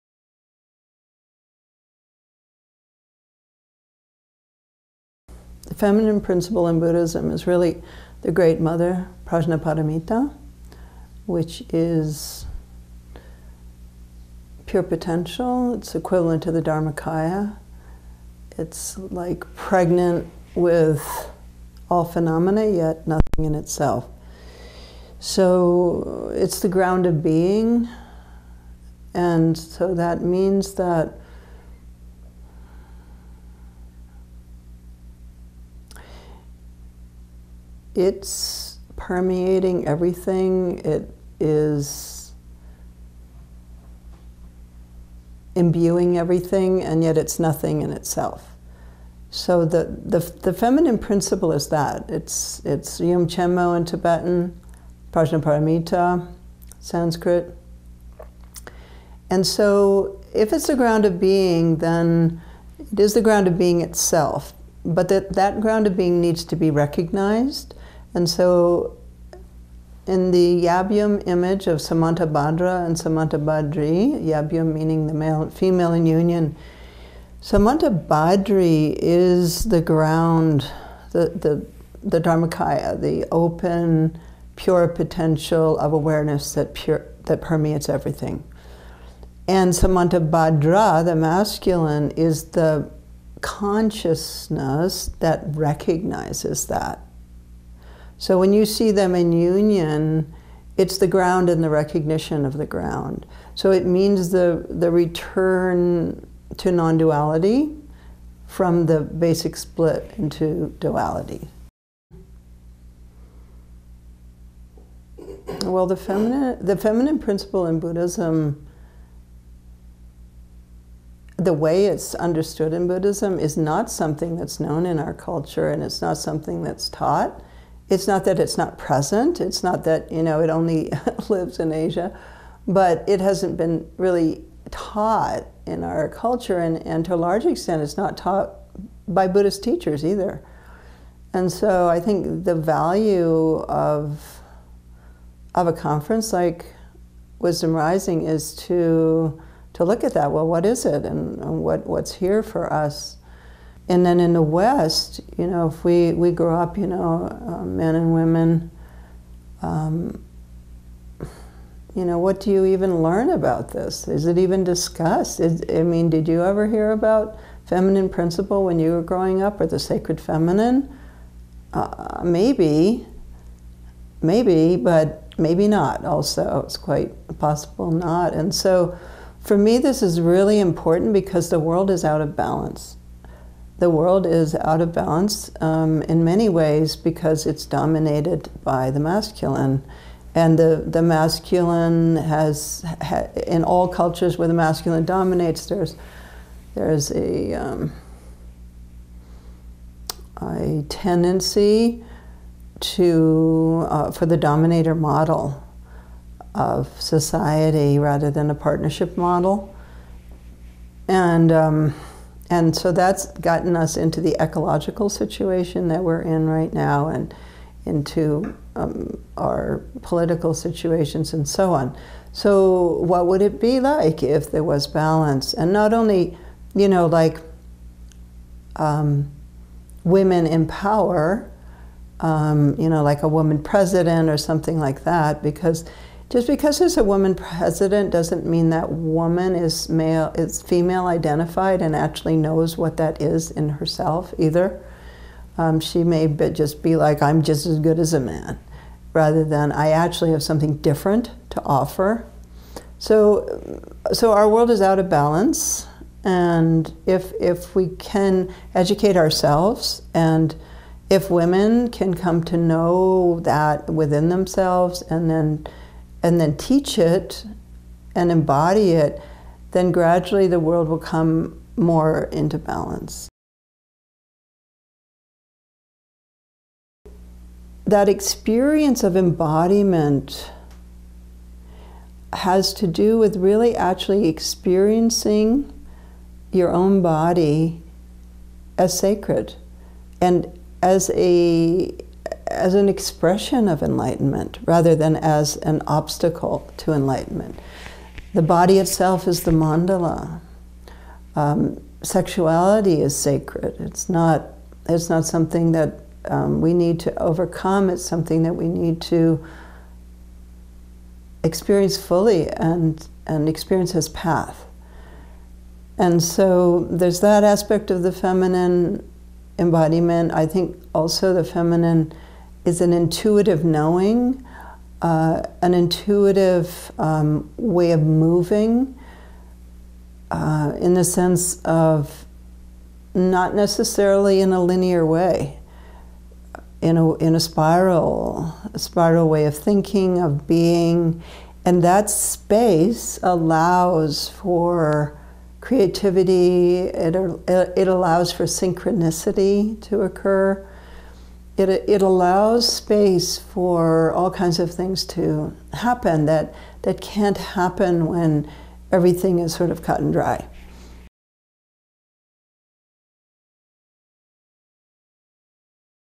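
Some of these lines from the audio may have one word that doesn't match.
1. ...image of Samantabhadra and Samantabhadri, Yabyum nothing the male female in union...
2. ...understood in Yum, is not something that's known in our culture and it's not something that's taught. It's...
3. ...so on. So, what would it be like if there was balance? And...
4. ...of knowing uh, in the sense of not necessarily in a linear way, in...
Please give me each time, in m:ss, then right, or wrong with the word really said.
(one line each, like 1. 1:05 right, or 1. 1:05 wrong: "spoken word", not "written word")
1. 1:11 wrong: "meaning", not "nothing"
2. 2:02 wrong: "Buddhism", not "Yum"
3. 3:41 right
4. 5:27 wrong: "moving", not "knowing".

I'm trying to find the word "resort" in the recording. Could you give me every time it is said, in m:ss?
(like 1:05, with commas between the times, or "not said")
not said.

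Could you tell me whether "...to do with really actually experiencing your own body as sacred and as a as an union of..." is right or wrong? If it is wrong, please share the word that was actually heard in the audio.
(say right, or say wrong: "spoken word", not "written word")
wrong: "expression", not "union".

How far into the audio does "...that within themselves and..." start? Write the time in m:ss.
4:23.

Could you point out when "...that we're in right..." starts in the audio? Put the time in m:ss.
3:35.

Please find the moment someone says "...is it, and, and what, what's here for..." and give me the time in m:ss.
2:30.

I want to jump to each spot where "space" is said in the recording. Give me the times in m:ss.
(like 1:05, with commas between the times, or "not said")
5:42, 5:52.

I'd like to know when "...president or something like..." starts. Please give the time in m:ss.
3:53.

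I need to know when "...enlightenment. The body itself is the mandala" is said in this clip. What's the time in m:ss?
4:56.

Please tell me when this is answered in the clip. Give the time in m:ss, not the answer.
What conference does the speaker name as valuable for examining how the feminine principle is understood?
2:27.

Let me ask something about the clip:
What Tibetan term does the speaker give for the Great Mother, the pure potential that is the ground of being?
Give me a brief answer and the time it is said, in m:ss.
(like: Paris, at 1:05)
Yum mo, at 0:53.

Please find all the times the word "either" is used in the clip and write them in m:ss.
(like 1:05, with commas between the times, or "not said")
2:20, 4:04.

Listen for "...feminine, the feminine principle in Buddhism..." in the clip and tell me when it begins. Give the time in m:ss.
1:55.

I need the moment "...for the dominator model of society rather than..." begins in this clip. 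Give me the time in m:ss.
3:24.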